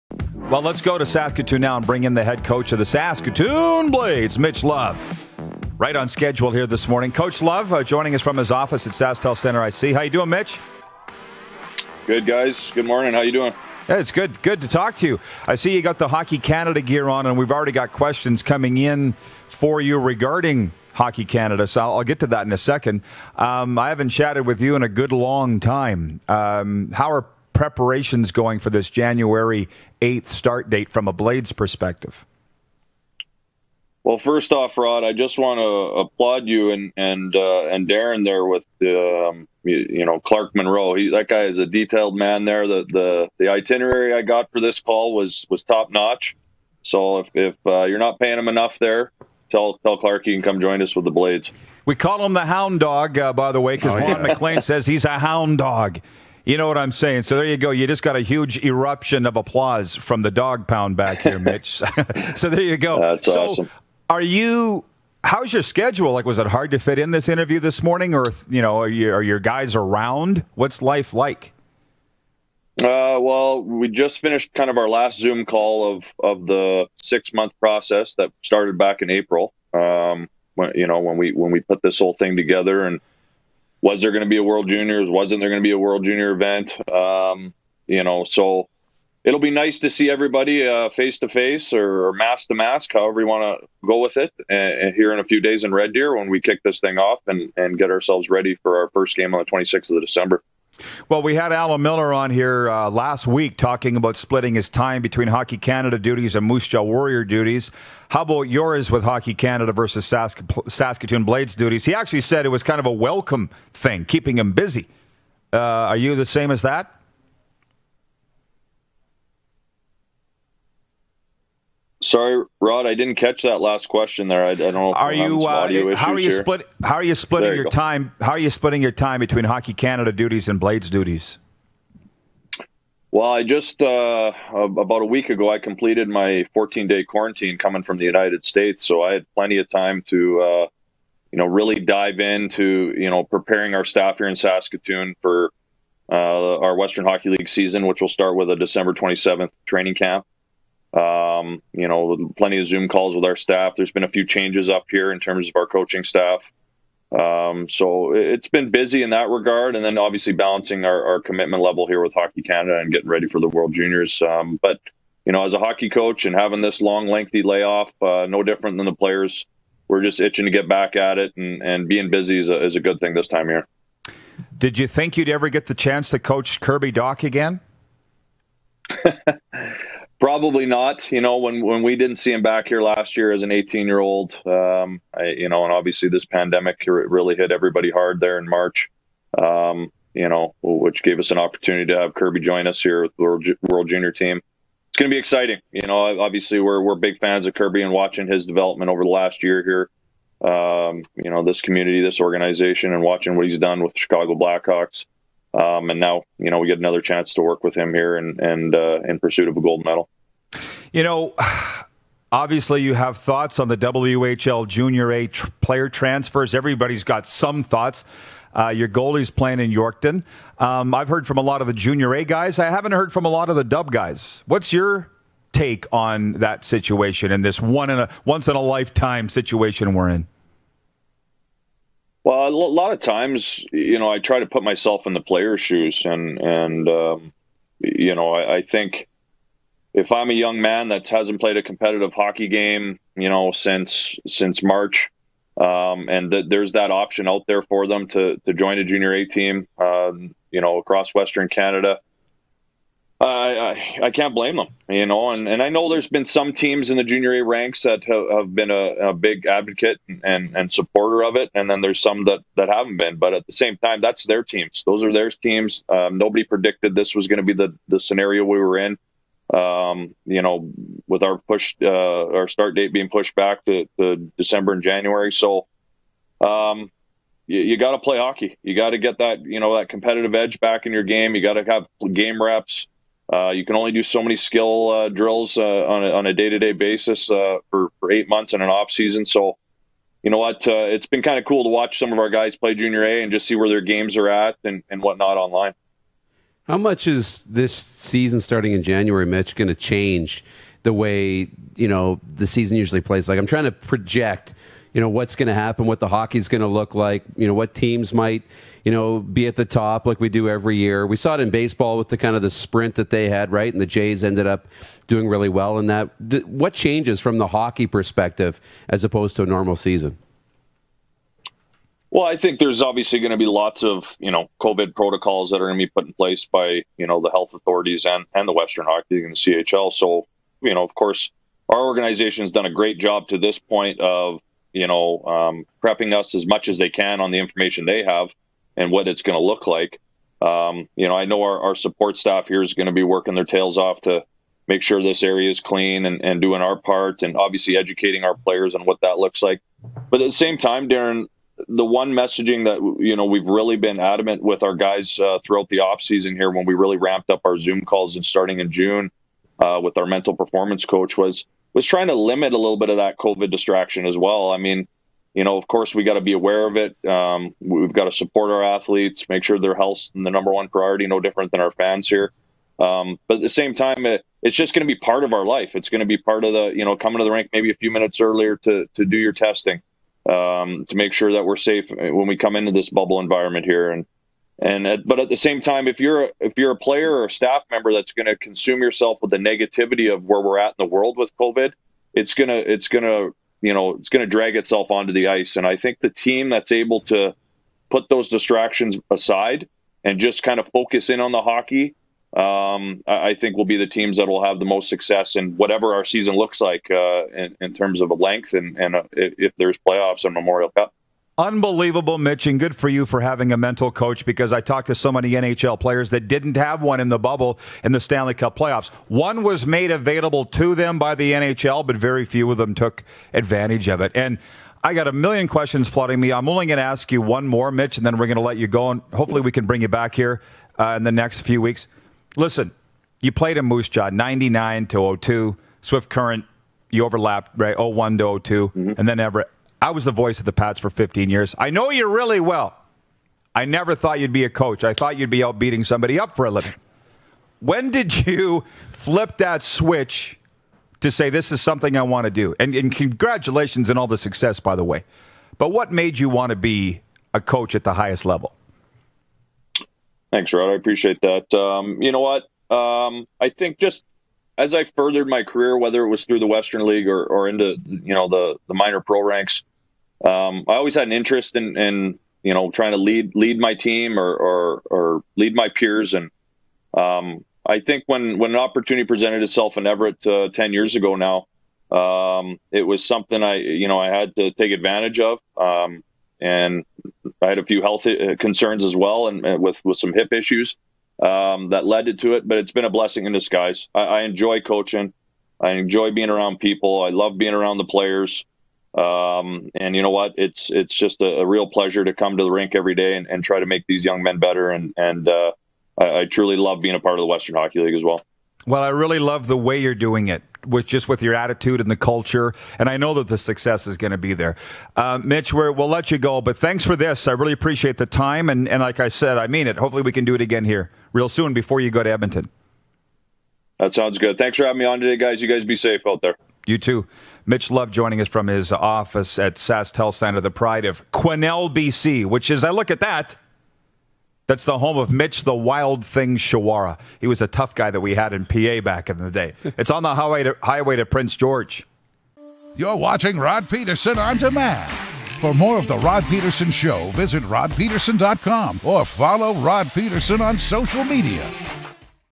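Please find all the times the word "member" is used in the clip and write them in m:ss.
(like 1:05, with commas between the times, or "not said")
6:27.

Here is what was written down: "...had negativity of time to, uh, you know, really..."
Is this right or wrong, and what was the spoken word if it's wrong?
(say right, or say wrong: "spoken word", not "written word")
wrong: "plenty", not "negativity".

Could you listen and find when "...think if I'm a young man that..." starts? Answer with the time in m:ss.
3:58.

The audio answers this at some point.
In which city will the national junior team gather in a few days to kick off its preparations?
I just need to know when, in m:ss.
1:35.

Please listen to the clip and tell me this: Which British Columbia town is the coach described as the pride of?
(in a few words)
Quesnel.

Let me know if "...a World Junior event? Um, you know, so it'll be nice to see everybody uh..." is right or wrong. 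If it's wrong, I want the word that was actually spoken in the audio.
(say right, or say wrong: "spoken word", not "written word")
right.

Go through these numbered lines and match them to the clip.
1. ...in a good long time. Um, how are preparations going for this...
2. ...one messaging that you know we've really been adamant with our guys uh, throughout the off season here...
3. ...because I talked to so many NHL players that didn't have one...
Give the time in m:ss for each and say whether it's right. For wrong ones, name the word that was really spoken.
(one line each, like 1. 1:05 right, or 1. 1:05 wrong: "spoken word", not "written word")
1. 0:24 right
2. 5:51 right
3. 6:54 right.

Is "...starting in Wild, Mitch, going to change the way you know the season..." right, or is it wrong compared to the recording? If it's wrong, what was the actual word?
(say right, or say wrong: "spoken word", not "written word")
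wrong: "January", not "Wild".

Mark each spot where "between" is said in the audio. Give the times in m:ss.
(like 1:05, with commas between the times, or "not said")
1:45, 2:09.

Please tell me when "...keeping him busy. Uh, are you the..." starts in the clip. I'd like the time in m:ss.
1:54.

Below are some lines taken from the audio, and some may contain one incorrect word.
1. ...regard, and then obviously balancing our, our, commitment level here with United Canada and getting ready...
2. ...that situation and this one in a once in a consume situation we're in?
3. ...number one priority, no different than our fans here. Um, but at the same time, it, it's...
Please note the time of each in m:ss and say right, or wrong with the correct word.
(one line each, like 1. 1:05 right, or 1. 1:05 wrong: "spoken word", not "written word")
1. 2:39 wrong: "Hockey", not "United"
2. 3:46 wrong: "lifetime", not "consume"
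3. 6:10 right.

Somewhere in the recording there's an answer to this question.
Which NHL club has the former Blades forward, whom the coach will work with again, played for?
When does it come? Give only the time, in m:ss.
3:23.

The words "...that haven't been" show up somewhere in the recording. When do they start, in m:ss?
4:22.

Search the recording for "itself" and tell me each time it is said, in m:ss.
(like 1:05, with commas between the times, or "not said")
6:34, 7:59.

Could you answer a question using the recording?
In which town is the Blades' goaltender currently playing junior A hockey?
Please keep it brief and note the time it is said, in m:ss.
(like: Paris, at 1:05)
Yorkton, at 3:39.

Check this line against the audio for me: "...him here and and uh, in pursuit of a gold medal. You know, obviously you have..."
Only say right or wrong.
right.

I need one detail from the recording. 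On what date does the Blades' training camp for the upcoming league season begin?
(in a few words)
December 27.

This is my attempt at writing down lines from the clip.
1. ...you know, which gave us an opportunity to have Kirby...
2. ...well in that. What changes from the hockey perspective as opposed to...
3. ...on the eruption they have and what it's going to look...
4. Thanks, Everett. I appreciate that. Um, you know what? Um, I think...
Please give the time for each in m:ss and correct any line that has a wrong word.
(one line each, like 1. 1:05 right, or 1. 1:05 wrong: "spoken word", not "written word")
1. 3:10 right
2. 5:15 right
3. 5:37 wrong: "information", not "eruption"
4. 7:40 wrong: "Rod", not "Everett".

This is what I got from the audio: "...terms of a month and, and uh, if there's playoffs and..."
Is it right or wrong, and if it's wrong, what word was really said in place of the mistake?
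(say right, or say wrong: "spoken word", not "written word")
wrong: "length", not "month".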